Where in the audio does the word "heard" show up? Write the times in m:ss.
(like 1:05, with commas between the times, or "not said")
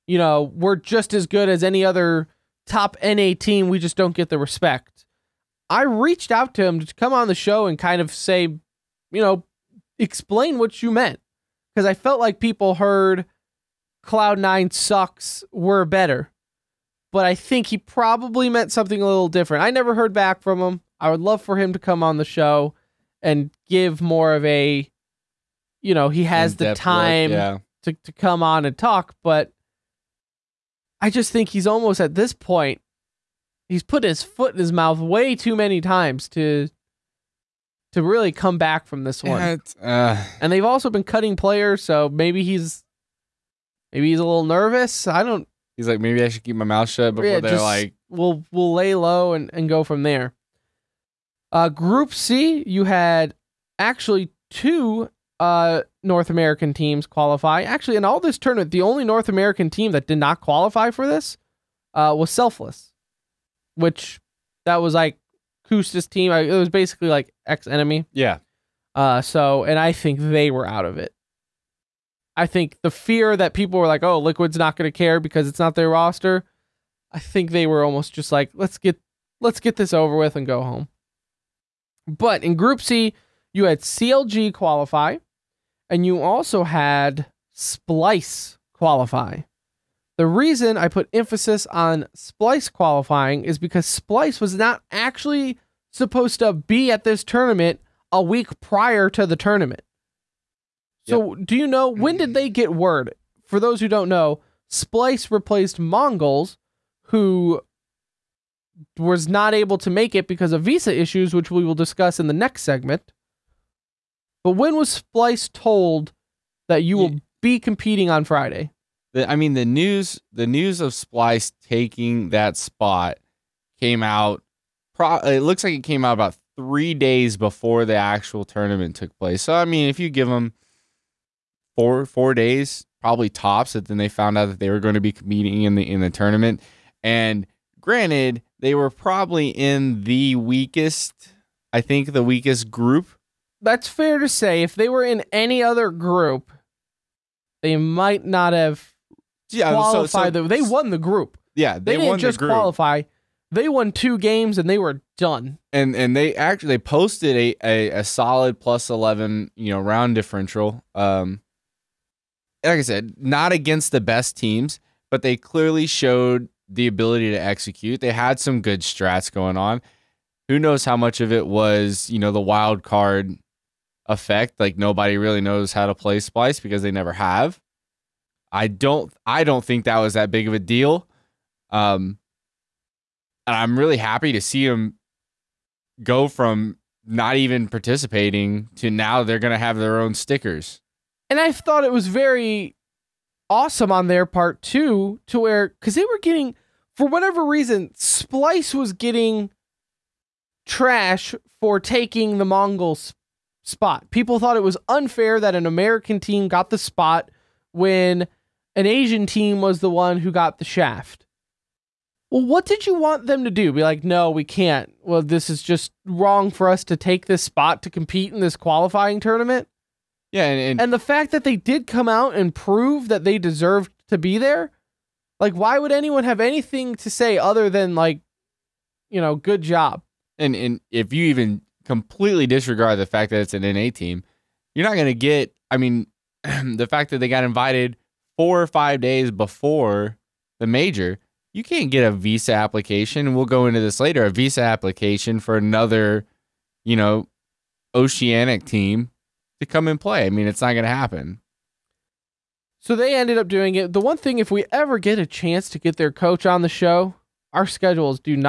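0:12, 0:19.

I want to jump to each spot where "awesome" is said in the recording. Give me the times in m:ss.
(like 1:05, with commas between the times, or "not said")
3:13.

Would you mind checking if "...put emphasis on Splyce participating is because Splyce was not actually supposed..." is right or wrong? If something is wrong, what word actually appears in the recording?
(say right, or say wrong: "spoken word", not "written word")
wrong: "qualifying", not "participating".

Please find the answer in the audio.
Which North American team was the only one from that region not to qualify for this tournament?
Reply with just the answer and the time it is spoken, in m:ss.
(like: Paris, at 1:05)
Selfless, at 1:02.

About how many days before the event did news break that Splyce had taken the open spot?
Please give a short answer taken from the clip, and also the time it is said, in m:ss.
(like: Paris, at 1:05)
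3, at 2:06.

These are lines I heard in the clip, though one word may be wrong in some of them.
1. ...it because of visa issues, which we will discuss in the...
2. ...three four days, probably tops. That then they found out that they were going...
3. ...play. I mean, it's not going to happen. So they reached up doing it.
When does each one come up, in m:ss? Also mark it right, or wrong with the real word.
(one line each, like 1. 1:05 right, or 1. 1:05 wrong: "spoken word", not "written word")
1. 1:50 right
2. 2:11 wrong: "four", not "three"
3. 4:09 wrong: "ended", not "reached".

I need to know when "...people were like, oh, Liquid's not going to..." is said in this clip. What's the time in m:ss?
1:13.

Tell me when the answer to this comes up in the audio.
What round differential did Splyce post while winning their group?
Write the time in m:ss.
2:38.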